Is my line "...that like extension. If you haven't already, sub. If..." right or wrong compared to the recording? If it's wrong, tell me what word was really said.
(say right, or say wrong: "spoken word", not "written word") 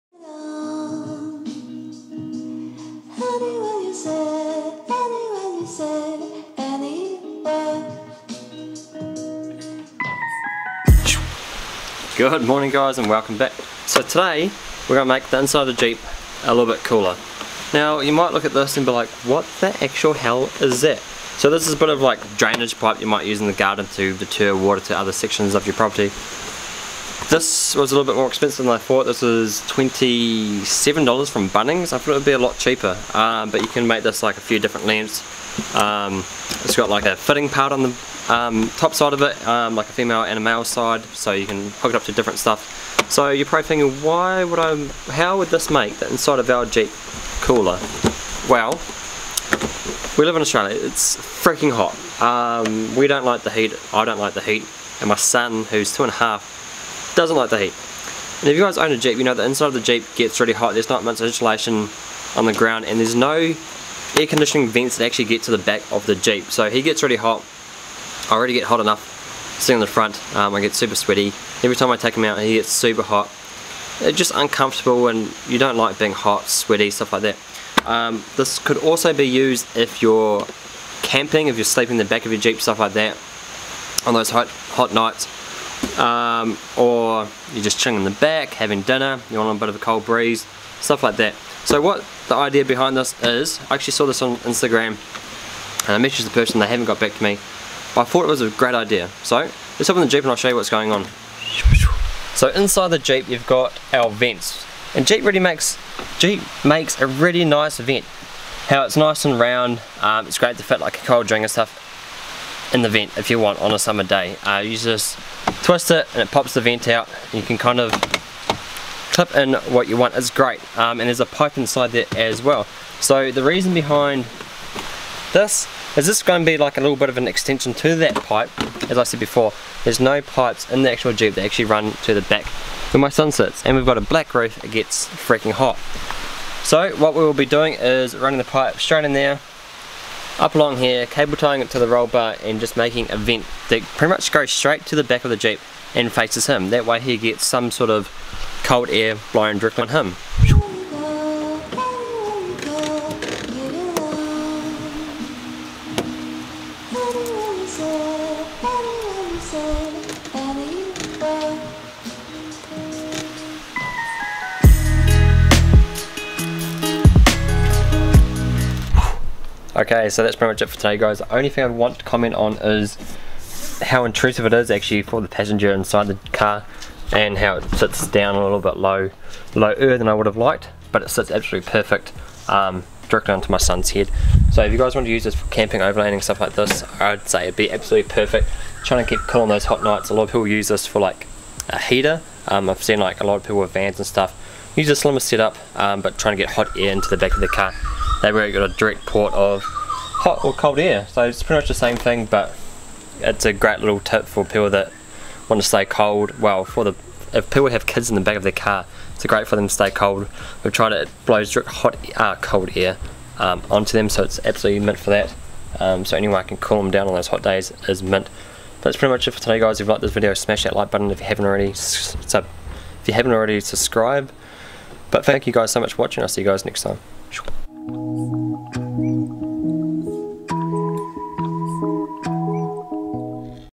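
wrong: "button", not "extension".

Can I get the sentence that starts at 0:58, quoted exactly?
And if you guys own a Jeep, you know the inside of the Jeep gets really hot.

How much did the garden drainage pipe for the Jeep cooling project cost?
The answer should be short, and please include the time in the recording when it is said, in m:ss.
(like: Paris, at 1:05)
$27, at 0:29.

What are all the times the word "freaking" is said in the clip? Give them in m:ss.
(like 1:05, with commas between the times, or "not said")
0:51, 2:15.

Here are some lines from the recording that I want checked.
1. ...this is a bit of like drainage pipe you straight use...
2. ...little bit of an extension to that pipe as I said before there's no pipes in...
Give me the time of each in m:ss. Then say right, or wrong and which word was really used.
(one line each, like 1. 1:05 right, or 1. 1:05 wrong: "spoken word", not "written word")
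1. 0:21 wrong: "might", not "straight"
2. 2:06 right.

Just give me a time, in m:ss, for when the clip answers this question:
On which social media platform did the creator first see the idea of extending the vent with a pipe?
1:34.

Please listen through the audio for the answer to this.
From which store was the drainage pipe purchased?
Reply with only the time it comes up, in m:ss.
0:31.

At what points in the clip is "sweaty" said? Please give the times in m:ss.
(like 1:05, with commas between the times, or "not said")
1:10, 1:16.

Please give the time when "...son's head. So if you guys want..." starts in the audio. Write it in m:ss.
3:03.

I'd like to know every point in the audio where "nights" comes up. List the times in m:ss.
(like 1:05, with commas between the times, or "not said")
1:24, 3:09.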